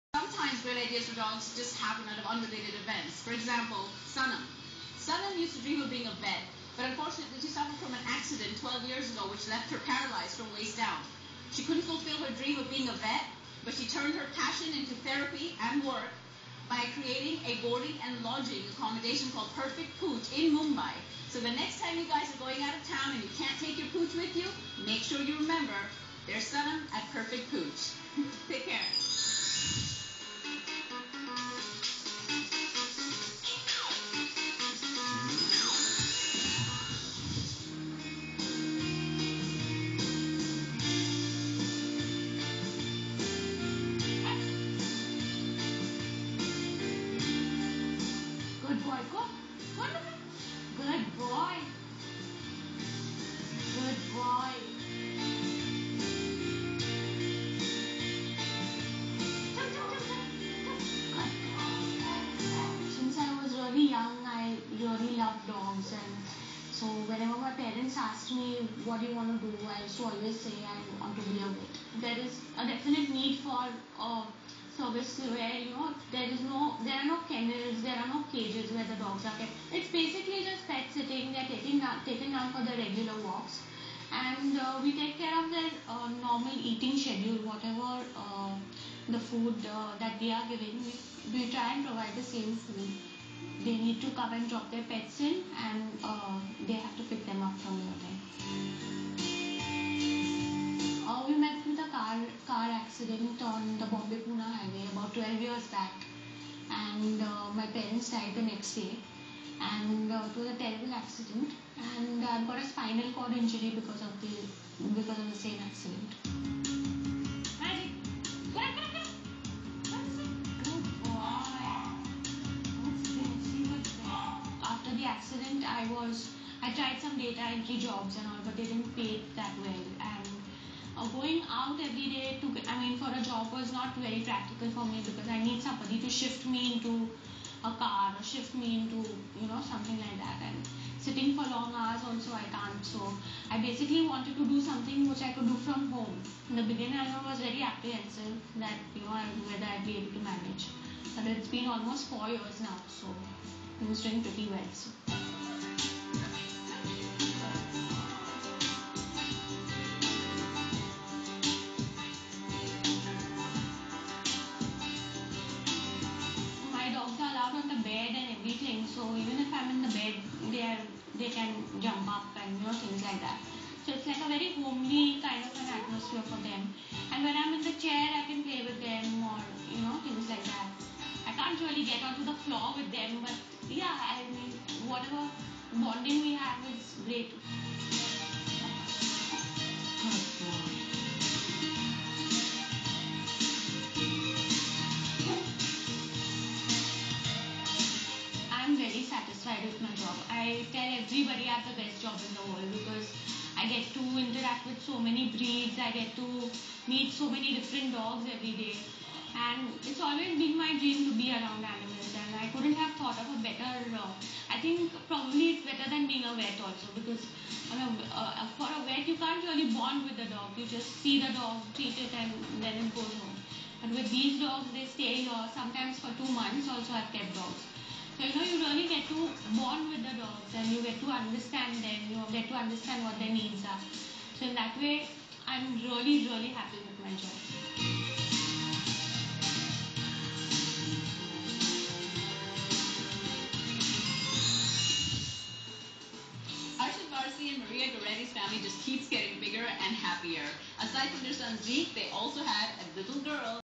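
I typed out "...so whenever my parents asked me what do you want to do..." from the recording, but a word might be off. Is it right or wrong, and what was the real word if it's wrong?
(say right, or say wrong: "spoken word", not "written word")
right.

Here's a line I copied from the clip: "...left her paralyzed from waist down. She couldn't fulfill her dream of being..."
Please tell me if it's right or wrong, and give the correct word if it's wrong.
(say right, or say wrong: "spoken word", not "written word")
right.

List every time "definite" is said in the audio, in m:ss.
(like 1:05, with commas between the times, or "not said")
1:12.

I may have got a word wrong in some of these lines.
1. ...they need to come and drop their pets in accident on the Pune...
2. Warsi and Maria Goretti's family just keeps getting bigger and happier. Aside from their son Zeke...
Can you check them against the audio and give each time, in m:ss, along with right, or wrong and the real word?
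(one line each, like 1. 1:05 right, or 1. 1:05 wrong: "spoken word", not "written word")
1. 1:33 wrong: "Bombay", not "Pune"
2. 4:07 right.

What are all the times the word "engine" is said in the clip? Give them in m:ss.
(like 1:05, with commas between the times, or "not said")
not said.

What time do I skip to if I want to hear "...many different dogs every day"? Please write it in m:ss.
3:27.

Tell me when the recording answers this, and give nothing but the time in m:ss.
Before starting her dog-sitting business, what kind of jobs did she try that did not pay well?
2:07.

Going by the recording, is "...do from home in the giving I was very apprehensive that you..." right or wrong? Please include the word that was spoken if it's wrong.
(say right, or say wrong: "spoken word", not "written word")
wrong: "beginning", not "giving".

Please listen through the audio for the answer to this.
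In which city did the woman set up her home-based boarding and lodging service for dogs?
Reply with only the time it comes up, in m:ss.
0:20.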